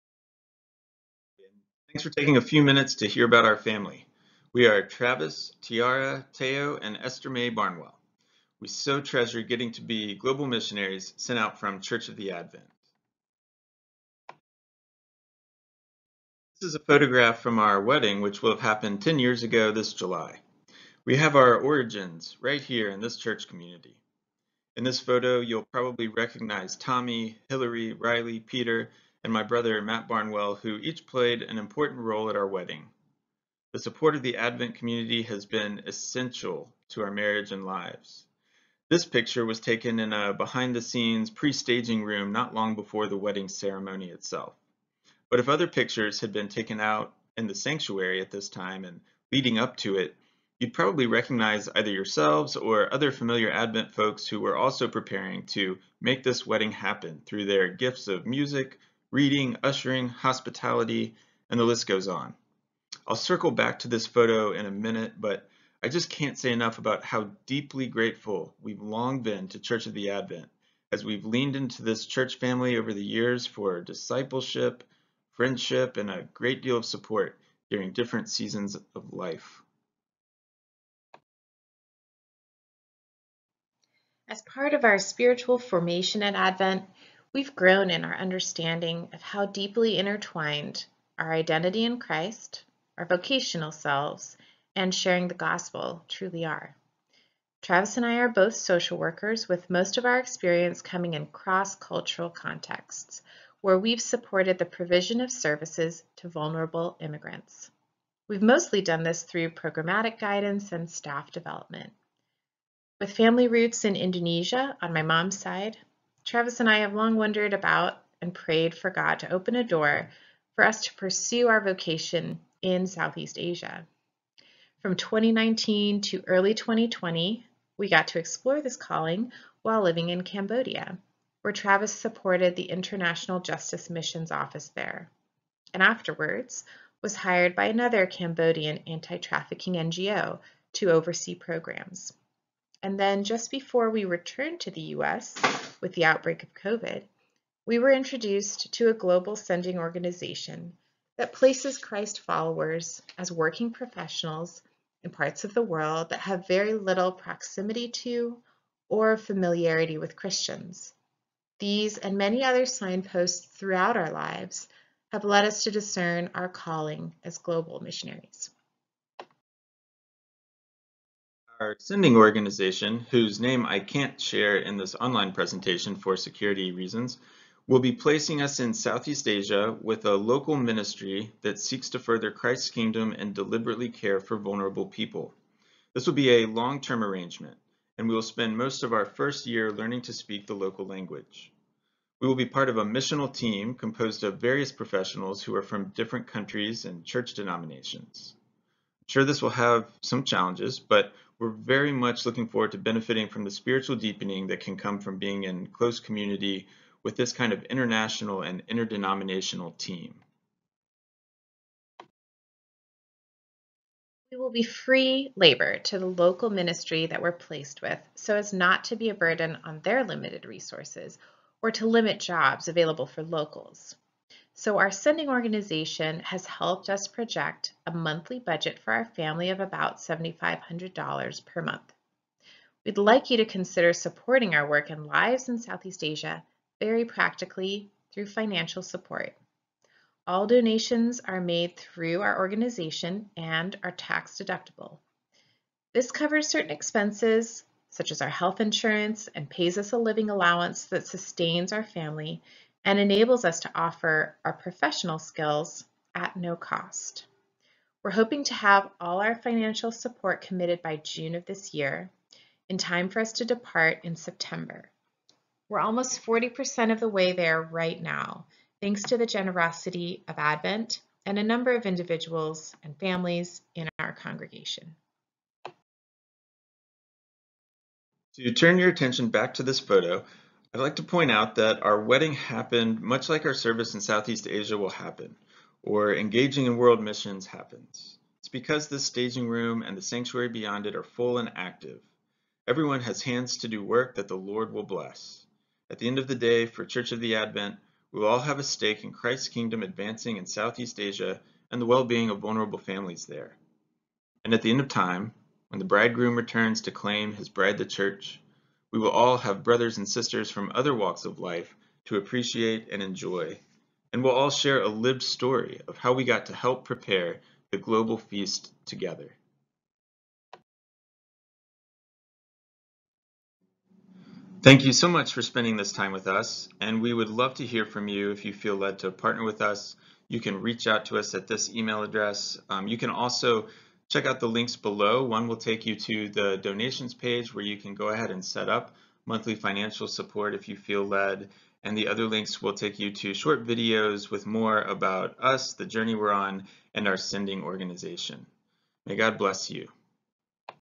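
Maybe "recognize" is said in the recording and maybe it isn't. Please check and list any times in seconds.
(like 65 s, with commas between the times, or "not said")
26 s, 51 s.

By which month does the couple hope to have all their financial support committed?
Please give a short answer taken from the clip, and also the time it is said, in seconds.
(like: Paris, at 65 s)
June, at 260 s.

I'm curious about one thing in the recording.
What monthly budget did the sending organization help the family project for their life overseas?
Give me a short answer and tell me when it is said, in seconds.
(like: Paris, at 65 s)
$7,500, at 229 s.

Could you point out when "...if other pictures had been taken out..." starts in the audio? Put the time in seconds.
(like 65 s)
45 s.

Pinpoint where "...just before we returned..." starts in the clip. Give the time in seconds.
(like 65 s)
143 s.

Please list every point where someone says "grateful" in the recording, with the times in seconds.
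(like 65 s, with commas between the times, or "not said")
67 s.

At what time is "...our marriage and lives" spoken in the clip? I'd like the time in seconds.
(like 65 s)
37 s.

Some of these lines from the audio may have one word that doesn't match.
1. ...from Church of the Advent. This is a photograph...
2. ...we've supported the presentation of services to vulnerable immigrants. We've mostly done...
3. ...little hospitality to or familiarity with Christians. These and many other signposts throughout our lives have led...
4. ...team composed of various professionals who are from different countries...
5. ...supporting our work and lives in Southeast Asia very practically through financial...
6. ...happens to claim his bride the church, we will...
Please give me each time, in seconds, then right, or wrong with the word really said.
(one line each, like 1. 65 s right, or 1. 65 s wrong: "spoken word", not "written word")
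1. 11 s right
2. 103 s wrong: "provision", not "presentation"
3. 156 s wrong: "proximity", not "hospitality"
4. 193 s right
5. 233 s right
6. 306 s wrong: "returns", not "happens".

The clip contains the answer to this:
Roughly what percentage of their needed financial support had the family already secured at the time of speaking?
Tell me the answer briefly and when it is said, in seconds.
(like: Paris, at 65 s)
40%, at 266 s.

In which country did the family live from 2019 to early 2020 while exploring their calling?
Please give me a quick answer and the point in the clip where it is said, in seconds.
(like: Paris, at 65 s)
Cambodia, at 130 s.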